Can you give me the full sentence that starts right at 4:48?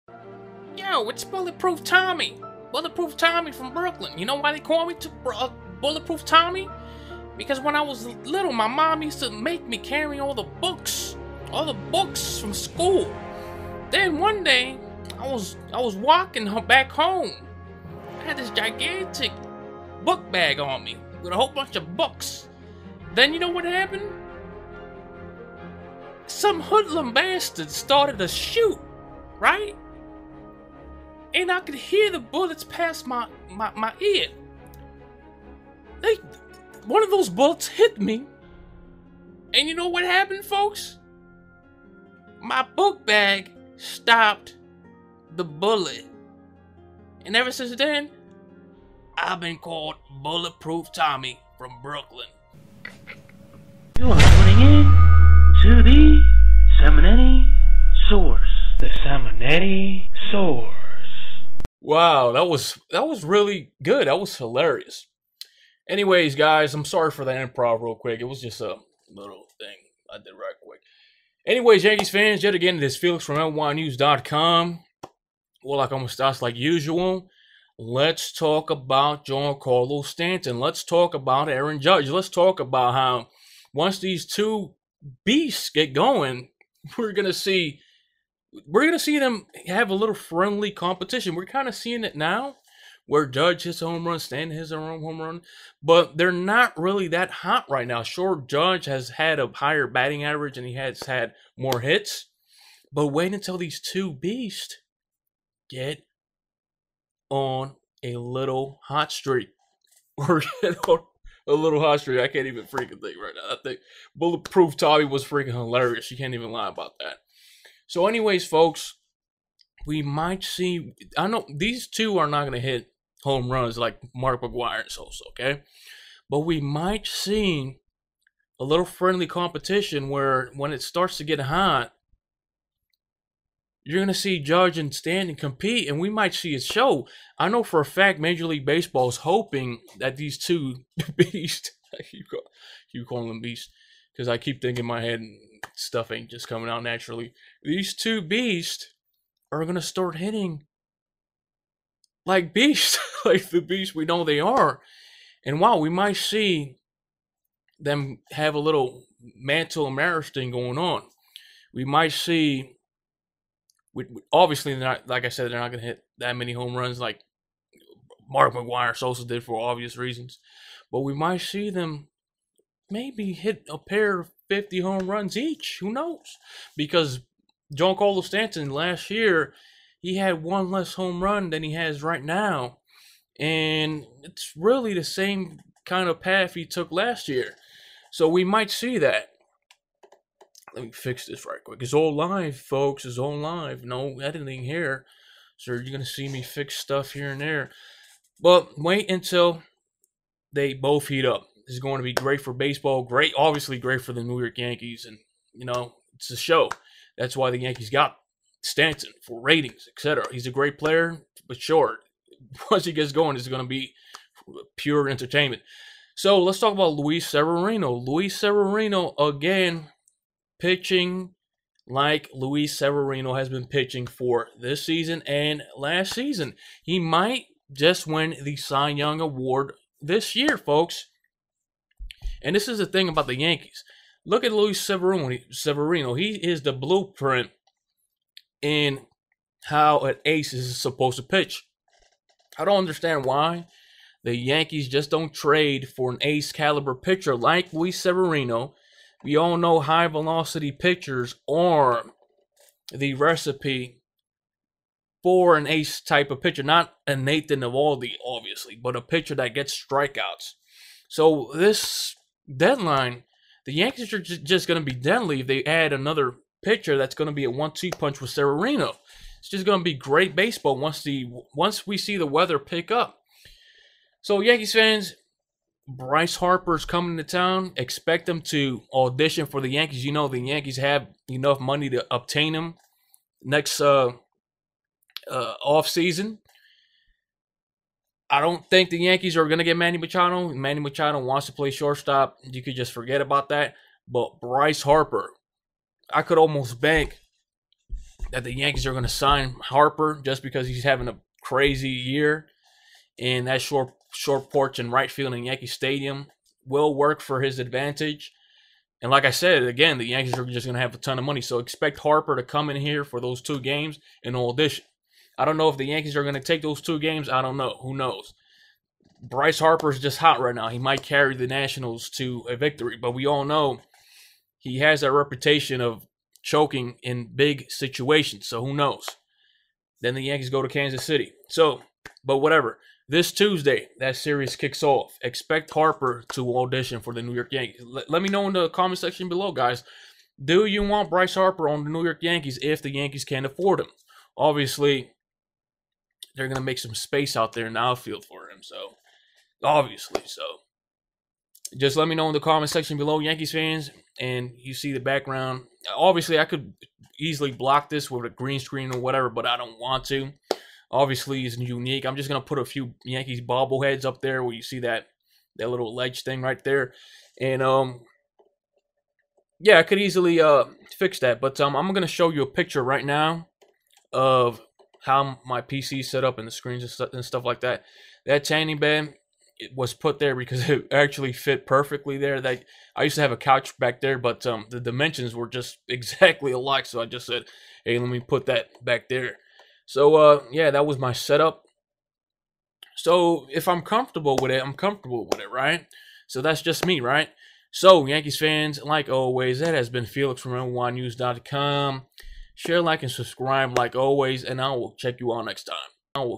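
I don't think the Yankees are going to get Manny Machado.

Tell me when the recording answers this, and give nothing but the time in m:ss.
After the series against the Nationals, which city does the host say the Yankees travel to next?
5:30.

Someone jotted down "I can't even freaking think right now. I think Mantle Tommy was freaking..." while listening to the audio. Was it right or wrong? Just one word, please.
wrong.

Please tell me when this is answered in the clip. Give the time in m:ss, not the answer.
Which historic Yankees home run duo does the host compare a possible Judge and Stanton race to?
2:39.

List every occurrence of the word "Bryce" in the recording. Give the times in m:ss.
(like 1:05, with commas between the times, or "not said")
4:35, 4:54, 5:19, 5:41.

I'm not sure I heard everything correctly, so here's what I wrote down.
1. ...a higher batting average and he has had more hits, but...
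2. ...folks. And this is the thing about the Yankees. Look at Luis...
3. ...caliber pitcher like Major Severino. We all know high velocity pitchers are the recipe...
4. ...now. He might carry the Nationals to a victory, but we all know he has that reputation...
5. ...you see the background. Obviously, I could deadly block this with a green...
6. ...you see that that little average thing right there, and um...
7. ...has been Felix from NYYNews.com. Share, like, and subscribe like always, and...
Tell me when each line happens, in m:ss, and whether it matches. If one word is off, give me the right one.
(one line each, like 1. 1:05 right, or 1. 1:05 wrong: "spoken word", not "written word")
1. 1:39 right
2. 3:50 right
3. 4:06 wrong: "Luis", not "Major"
4. 5:20 right
5. 5:54 wrong: "easily", not "deadly"
6. 6:04 wrong: "ledge", not "average"
7. 6:39 right.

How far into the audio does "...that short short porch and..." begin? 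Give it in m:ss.
5:03.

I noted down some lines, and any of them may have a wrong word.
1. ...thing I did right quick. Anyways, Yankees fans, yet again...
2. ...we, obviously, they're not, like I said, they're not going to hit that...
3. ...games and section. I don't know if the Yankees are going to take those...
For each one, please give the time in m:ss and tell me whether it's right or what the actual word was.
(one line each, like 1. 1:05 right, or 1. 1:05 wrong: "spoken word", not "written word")
1. 1:09 right
2. 2:43 right
3. 5:13 wrong: "audition", not "section".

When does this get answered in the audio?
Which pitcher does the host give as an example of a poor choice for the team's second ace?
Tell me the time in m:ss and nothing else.
4:17.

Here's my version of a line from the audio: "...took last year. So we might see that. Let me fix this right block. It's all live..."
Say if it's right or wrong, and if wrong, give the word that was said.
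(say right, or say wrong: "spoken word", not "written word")
wrong: "quick", not "block".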